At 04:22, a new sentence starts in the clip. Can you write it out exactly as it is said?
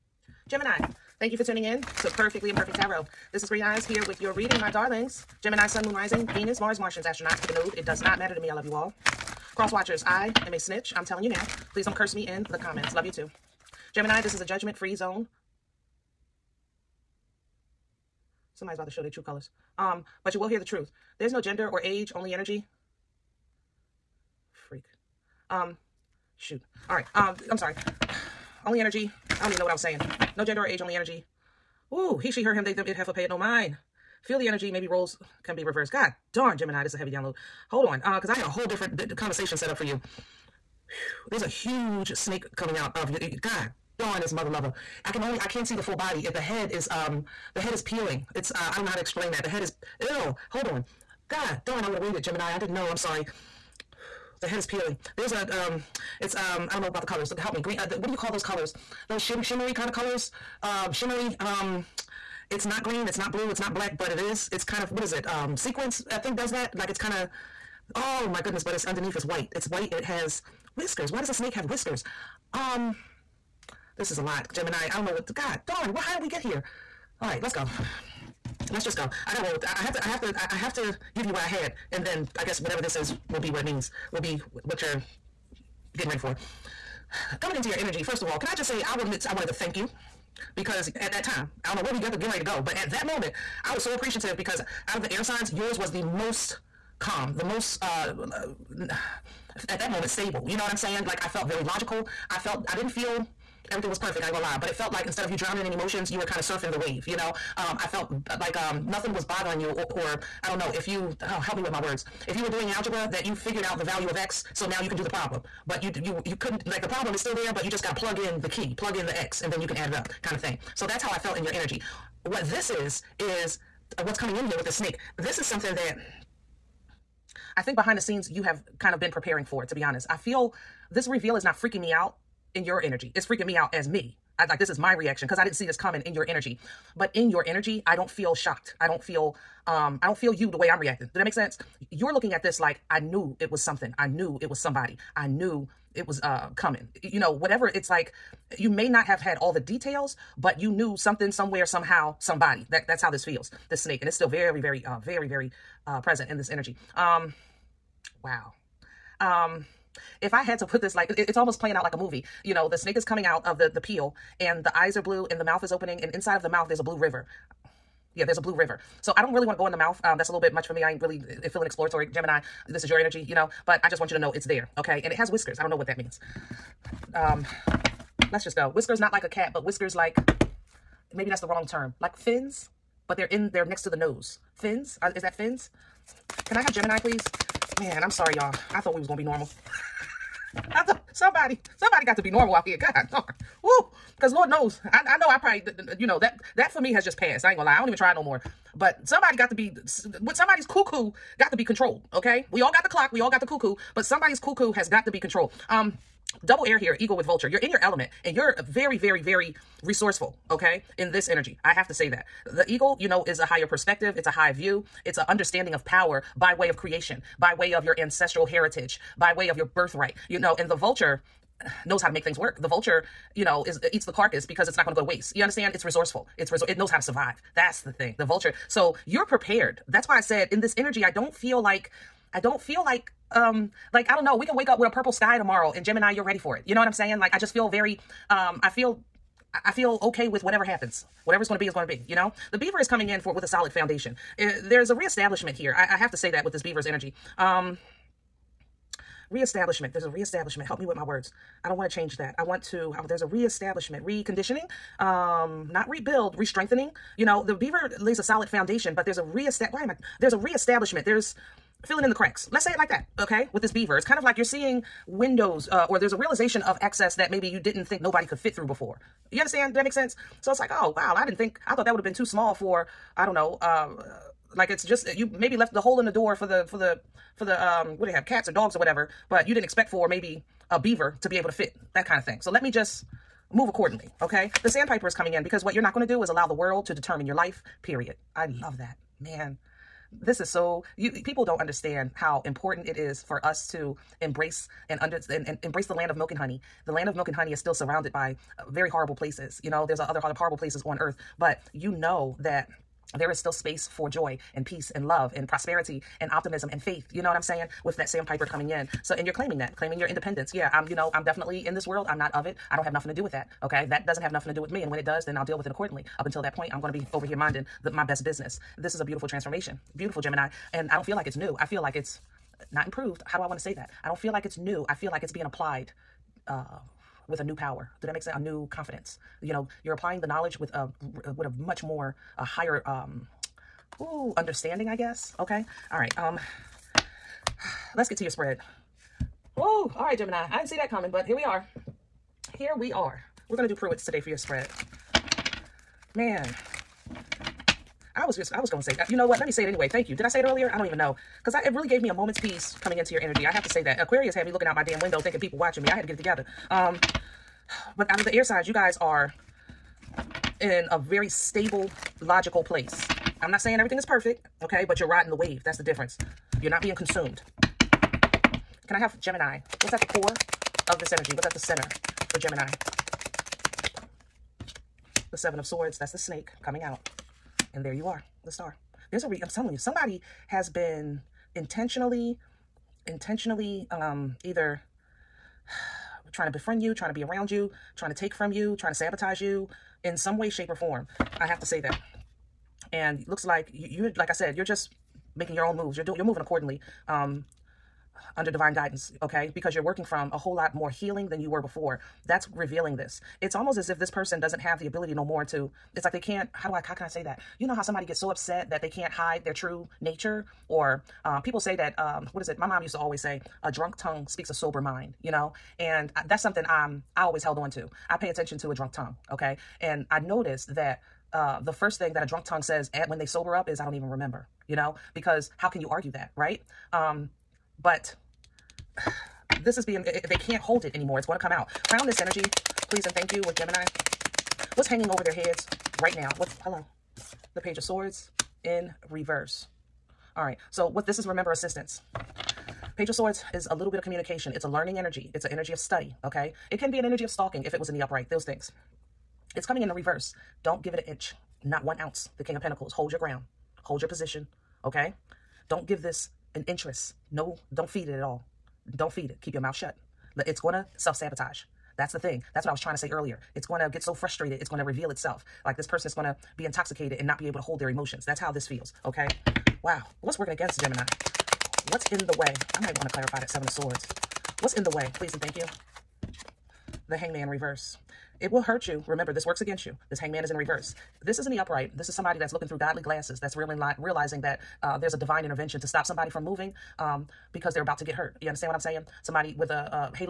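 Let's say it like that, okay?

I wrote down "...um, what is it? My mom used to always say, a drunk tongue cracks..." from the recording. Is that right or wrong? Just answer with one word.
wrong.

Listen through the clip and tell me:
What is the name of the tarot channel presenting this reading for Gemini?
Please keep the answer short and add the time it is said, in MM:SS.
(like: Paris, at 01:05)
Perfectly Imperfect Tarot, at 00:02.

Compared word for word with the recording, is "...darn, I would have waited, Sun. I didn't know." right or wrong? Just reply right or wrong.
wrong.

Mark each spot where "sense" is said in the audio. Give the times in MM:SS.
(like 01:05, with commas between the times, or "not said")
02:21, 04:29, 05:28.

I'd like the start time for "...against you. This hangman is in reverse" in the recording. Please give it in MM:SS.
07:59.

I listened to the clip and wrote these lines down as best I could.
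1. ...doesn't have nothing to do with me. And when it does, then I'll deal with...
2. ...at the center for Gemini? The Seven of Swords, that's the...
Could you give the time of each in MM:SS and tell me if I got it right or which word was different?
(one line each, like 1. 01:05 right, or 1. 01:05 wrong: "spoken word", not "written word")
1. 05:14 right
2. 06:11 right.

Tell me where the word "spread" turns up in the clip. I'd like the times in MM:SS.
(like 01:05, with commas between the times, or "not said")
05:38, 05:44.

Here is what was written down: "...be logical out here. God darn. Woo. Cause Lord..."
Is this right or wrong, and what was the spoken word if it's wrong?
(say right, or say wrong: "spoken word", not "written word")
wrong: "normal", not "logical".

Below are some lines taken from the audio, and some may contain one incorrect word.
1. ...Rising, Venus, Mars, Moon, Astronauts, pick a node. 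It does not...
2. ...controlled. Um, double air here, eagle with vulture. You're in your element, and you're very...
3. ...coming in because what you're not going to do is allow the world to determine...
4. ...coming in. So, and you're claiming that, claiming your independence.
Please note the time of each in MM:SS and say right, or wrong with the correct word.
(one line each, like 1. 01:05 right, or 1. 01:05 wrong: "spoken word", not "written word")
1. 00:05 wrong: "Martians", not "Moon"
2. 03:25 right
3. 04:45 right
4. 05:08 right.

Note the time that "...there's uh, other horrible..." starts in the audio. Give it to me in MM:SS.
04:59.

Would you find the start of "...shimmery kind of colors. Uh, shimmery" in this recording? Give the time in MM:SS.
00:59.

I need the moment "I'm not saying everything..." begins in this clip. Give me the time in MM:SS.
06:03.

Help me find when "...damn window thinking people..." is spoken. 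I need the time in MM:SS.
05:54.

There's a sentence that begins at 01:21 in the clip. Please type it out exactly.
And then I guess whatever this is will be what it means, will be what you're getting ready for.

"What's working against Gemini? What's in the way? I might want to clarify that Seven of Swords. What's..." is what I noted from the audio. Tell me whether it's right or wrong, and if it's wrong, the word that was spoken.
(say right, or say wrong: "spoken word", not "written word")
right.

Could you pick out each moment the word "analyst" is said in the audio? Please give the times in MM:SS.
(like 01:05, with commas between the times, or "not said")
not said.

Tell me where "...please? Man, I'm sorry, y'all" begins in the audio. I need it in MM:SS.
03:06.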